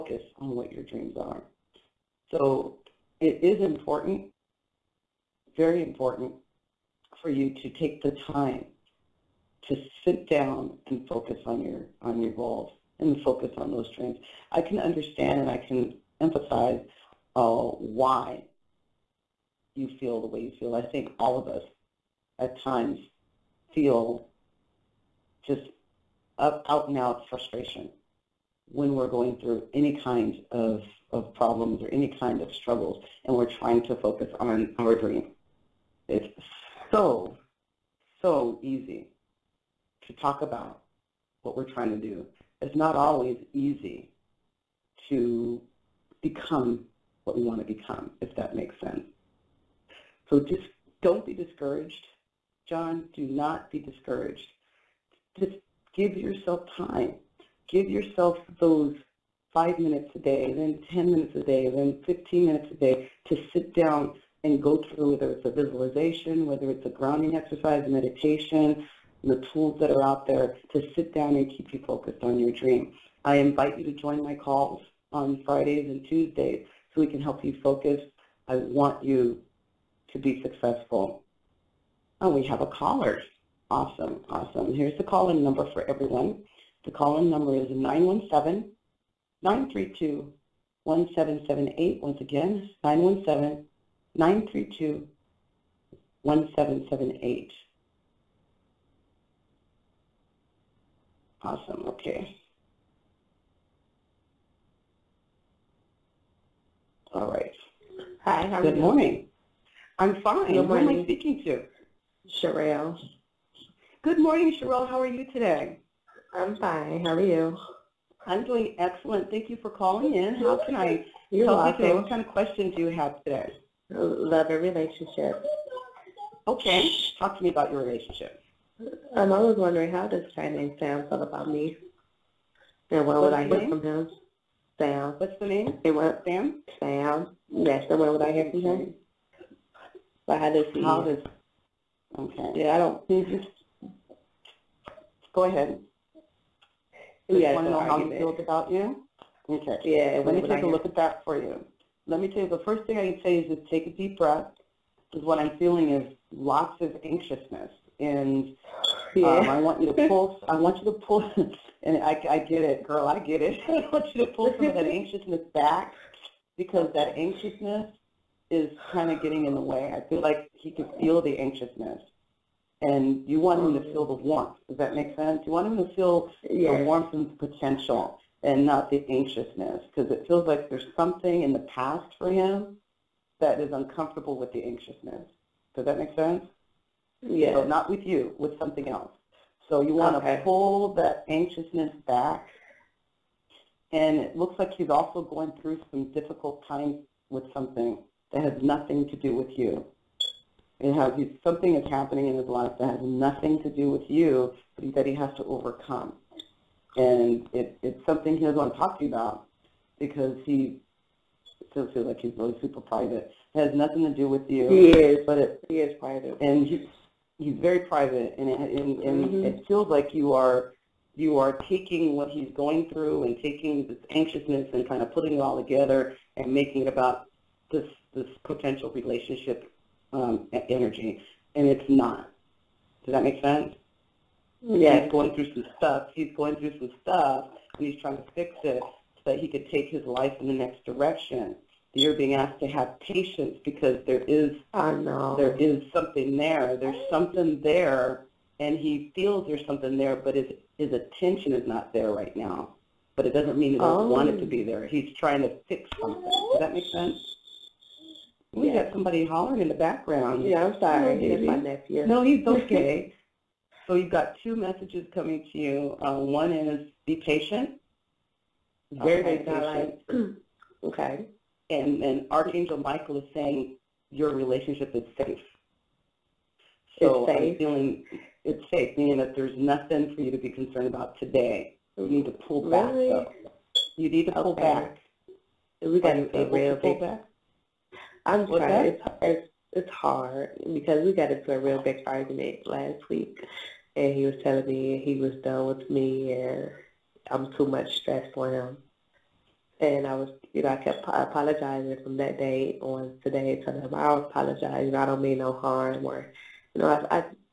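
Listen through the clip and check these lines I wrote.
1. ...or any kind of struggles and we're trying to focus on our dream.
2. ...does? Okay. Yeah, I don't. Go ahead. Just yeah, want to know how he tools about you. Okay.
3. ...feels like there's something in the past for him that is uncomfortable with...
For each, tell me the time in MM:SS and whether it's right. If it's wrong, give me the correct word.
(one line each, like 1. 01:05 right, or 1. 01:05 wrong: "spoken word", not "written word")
1. 00:31 right
2. 02:21 wrong: "feels", not "tools"
3. 03:00 right.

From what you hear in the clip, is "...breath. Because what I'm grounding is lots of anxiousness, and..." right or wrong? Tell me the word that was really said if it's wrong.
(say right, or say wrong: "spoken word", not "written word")
wrong: "feeling", not "grounding".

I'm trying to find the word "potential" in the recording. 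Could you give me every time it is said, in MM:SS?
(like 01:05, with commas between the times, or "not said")
02:57, 03:48.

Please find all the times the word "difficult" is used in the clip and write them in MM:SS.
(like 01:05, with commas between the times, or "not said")
03:16.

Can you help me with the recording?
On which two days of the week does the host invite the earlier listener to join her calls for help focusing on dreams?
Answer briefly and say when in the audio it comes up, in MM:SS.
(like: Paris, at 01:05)
Fridays and Tuesdays, at 01:15.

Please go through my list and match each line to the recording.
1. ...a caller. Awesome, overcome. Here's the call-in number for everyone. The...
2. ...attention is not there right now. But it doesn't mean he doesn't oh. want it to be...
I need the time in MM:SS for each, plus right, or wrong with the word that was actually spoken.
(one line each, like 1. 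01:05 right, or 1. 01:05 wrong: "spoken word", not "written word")
1. 01:22 wrong: "awesome", not "overcome"
2. 04:10 right.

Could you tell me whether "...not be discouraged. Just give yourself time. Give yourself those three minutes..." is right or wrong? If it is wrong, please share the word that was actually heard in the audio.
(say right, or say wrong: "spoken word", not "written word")
wrong: "five", not "three".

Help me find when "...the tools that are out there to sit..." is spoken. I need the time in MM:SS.
01:09.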